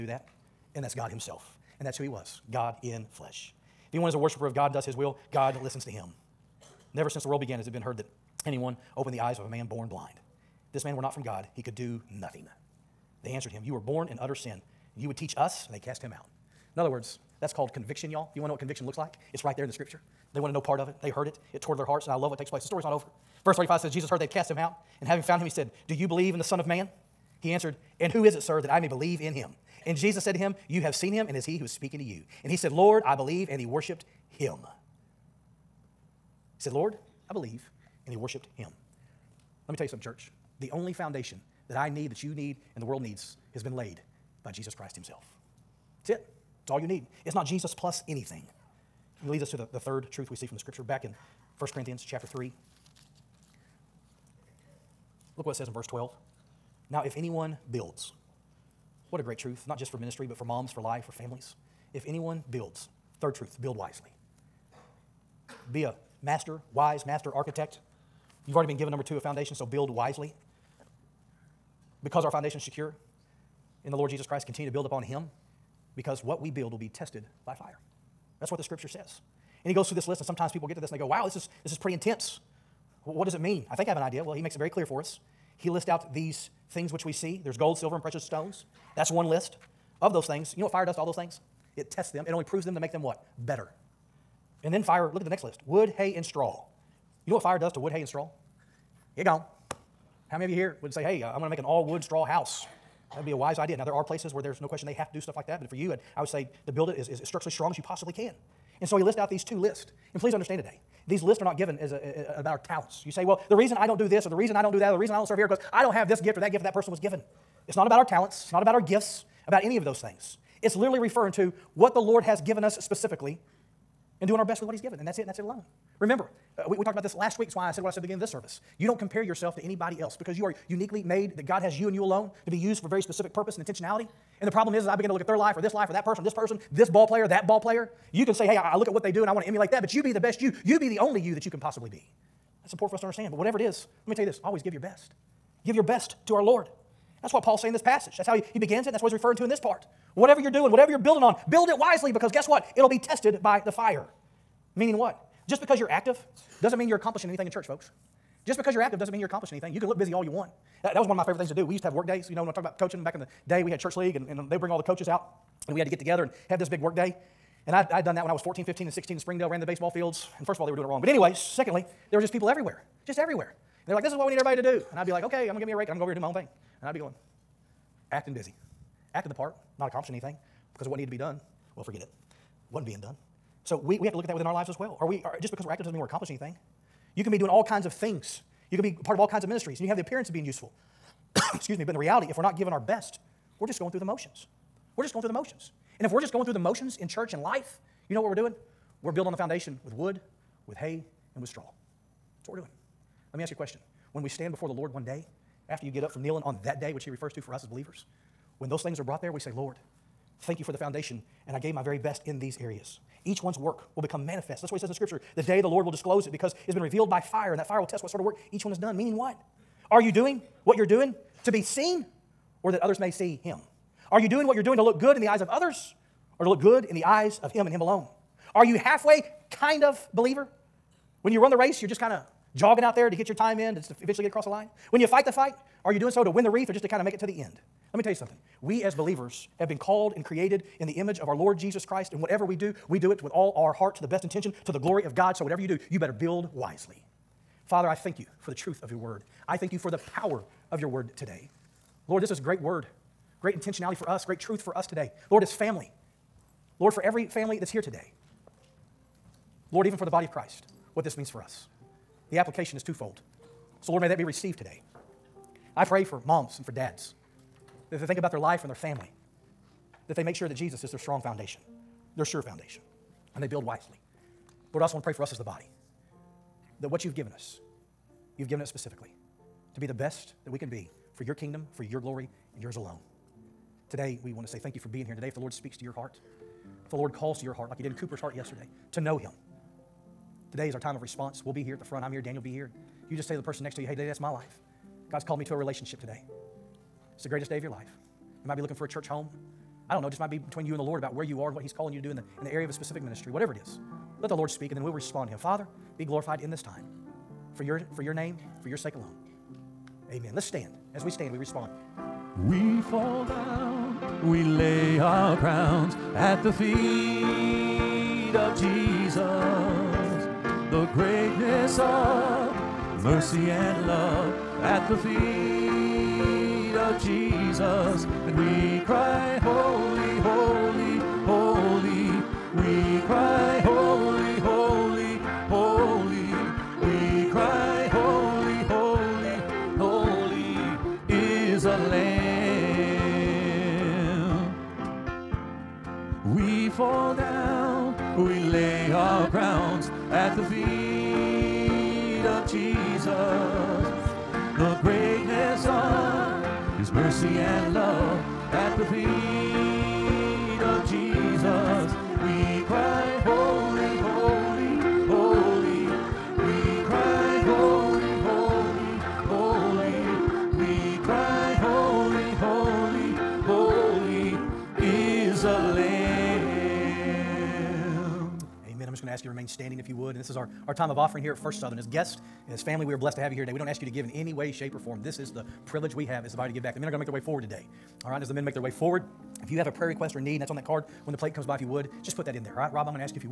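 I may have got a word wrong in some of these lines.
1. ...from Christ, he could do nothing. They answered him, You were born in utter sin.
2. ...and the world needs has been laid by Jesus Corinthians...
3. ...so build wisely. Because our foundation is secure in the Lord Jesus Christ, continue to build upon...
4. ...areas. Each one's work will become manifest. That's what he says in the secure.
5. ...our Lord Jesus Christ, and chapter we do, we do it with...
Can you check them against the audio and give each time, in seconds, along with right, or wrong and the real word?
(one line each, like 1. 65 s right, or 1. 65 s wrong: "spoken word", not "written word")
1. 11 s wrong: "God", not "Christ"
2. 42 s wrong: "Christ", not "Corinthians"
3. 69 s right
4. 212 s wrong: "scripture", not "secure"
5. 241 s wrong: "whatever", not "chapter".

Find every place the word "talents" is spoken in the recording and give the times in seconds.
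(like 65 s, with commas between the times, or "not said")
112 s, 118 s.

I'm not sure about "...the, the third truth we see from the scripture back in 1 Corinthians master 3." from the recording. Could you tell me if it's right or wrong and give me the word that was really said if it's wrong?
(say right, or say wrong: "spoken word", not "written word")
wrong: "chapter", not "master".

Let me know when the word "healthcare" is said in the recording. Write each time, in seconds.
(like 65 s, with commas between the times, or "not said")
not said.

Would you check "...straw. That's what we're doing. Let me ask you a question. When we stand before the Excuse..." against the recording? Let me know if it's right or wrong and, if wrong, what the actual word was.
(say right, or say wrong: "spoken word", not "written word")
wrong: "Lord", not "Excuse".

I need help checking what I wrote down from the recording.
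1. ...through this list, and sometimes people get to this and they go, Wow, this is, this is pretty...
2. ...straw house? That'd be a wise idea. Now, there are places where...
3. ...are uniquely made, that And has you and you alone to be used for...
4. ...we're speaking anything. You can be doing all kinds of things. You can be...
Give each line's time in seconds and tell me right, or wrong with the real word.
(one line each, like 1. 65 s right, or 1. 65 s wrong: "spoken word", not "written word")
1. 79 s right
2. 102 s right
3. 130 s wrong: "God", not "And"
4. 185 s wrong: "accomplishing", not "speaking".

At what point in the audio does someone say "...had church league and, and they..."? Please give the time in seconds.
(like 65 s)
163 s.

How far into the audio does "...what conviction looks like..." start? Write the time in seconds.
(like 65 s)
18 s.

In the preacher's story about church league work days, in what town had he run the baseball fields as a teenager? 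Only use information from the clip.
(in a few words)
Springdale.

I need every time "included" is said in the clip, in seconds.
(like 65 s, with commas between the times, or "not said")
not said.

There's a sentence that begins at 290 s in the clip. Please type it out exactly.
Today is our time of response.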